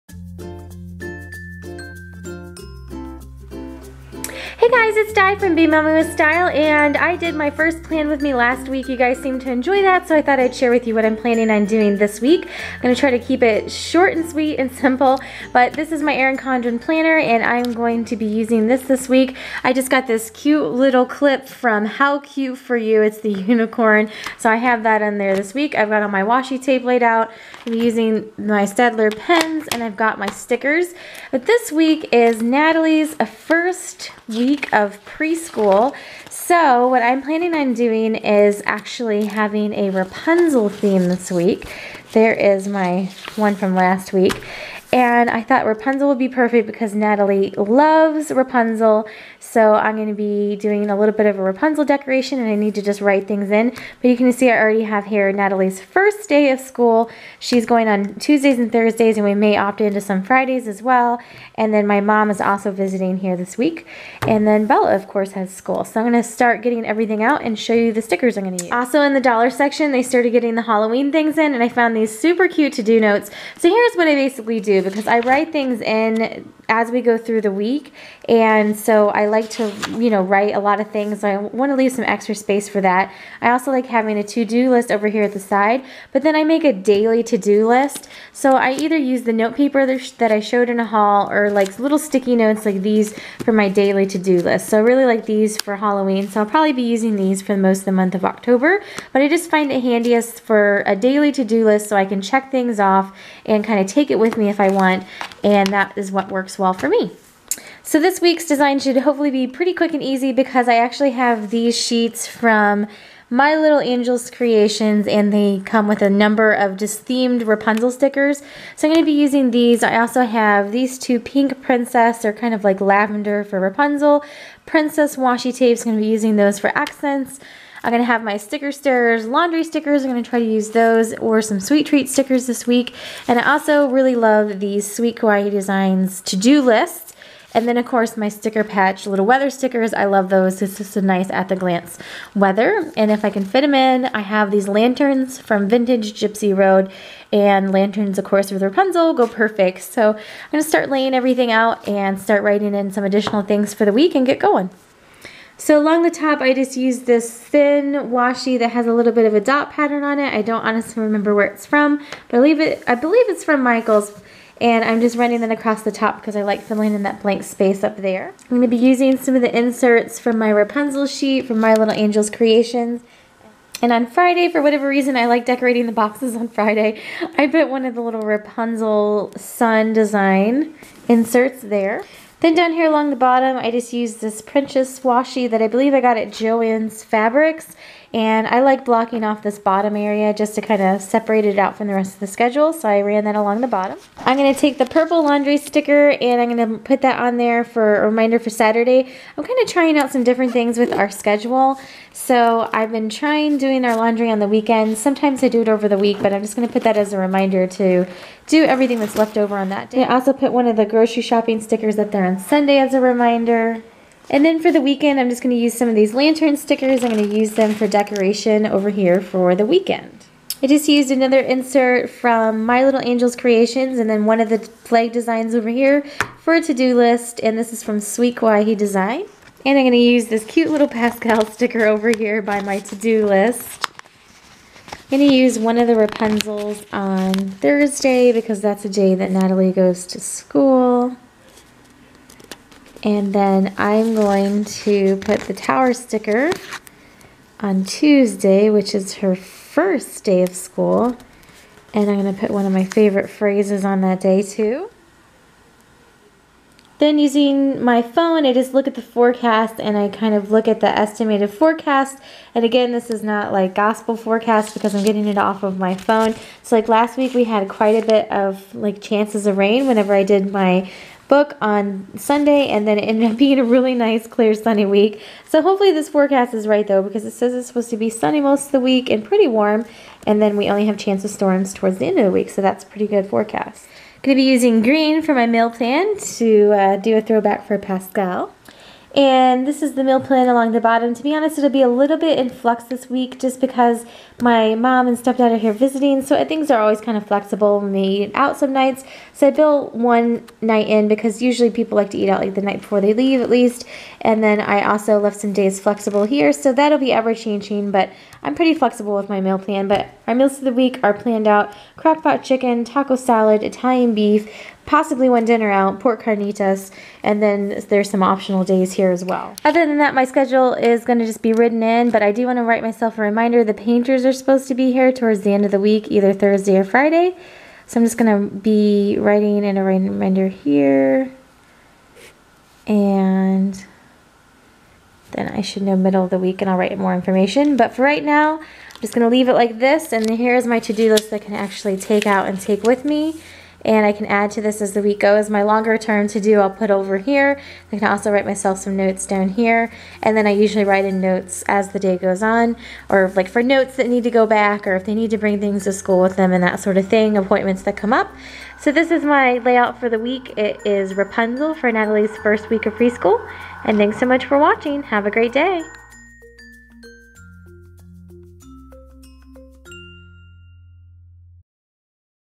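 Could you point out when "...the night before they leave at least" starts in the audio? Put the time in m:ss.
5:02.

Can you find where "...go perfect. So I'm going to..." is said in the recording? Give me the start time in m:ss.
2:29.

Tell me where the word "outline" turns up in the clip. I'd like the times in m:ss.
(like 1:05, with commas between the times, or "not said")
not said.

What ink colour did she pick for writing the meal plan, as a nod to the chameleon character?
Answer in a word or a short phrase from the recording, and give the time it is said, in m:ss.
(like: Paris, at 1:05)
green, at 4:44.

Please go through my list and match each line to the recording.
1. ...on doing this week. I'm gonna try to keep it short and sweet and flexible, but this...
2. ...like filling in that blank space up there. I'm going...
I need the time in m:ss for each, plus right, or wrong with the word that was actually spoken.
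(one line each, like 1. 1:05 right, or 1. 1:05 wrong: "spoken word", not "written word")
1. 0:11 wrong: "simple", not "flexible"
2. 2:46 right.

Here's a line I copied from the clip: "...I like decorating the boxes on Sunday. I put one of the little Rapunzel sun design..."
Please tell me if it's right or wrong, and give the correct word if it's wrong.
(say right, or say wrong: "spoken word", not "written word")
wrong: "Friday", not "Sunday".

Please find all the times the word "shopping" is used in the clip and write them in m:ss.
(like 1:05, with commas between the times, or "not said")
3:31.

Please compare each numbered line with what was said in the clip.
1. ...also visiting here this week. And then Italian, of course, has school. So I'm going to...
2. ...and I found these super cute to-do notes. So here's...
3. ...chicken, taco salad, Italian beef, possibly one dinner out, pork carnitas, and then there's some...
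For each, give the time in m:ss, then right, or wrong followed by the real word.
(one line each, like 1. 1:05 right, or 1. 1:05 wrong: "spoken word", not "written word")
1. 1:02 wrong: "Bella", not "Italian"
2. 1:11 right
3. 5:12 right.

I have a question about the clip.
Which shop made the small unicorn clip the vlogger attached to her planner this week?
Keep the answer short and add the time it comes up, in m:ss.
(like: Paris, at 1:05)
How Cute For You, at 0:21.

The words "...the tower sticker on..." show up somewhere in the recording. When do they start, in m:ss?
4:05.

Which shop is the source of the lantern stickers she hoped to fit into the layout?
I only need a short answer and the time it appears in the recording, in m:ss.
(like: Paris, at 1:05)
Vintage Gypsy Road, at 2:25.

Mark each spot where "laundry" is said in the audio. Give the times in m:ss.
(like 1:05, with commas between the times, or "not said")
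2:09, 3:15, 3:23.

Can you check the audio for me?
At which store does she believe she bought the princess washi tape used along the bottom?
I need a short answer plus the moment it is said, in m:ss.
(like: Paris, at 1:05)
Joann's Fabrics, at 3:06.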